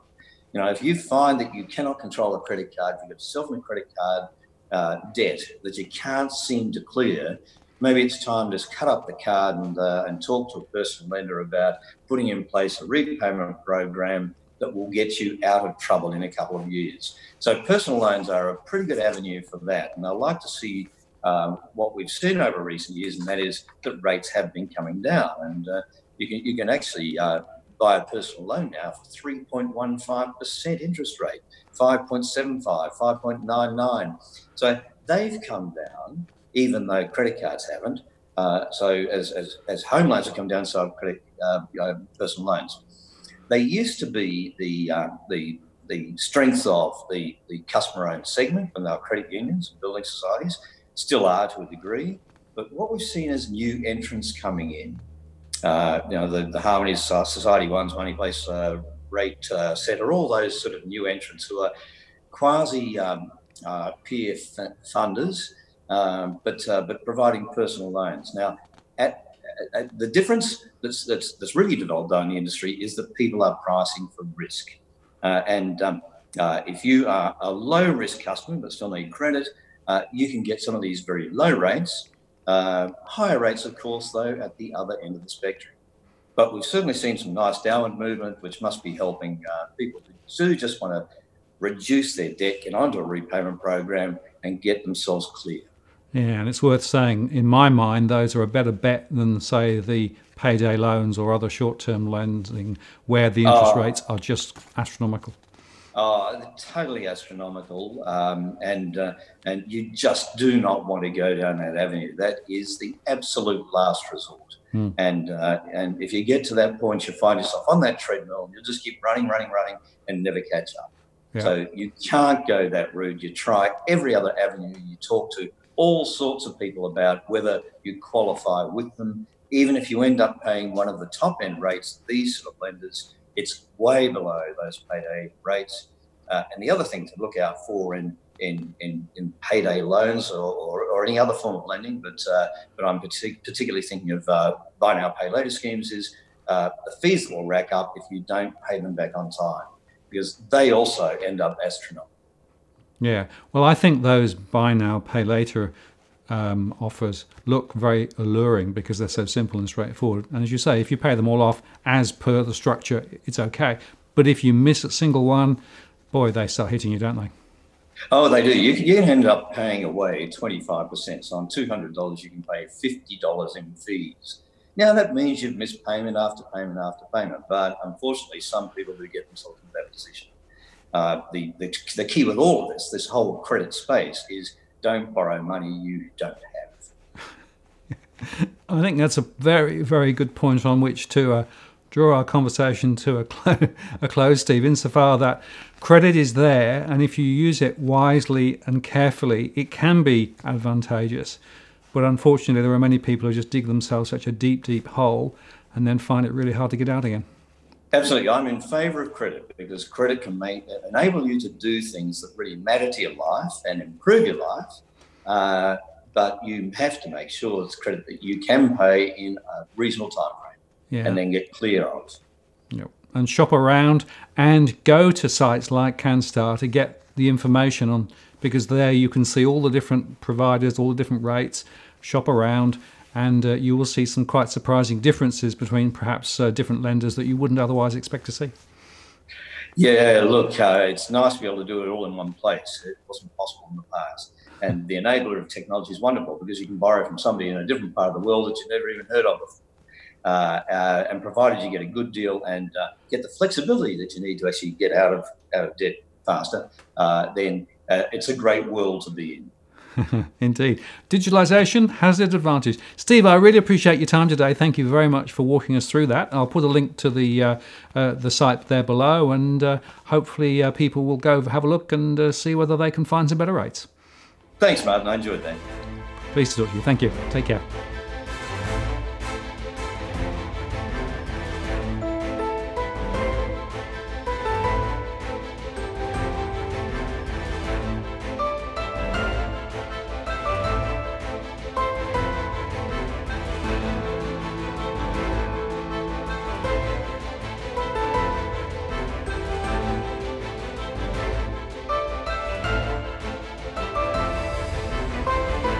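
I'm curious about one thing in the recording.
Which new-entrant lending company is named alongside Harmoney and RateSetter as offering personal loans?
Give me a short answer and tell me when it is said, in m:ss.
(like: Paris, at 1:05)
Money Place, at 0:57.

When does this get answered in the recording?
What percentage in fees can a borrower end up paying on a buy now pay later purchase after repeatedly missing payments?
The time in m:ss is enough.
2:50.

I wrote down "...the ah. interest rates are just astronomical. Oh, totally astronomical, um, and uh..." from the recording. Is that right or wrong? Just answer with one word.
right.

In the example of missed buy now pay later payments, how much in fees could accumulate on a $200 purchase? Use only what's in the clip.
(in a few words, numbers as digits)
$50.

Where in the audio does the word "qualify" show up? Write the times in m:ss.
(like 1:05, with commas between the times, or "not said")
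2:08.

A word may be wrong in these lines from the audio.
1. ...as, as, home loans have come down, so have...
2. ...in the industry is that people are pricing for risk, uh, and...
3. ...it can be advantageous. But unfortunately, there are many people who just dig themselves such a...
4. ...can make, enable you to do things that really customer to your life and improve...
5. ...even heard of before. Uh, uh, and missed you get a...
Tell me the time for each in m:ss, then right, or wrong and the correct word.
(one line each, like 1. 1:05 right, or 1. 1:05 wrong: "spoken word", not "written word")
1. 0:39 right
2. 1:12 right
3. 3:19 right
4. 3:30 wrong: "matter", not "customer"
5. 4:08 wrong: "provided", not "missed".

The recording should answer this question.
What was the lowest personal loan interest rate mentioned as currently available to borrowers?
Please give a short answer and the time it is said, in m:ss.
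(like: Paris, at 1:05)
3.15%, at 0:29.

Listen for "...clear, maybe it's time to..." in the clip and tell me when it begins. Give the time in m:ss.
0:06.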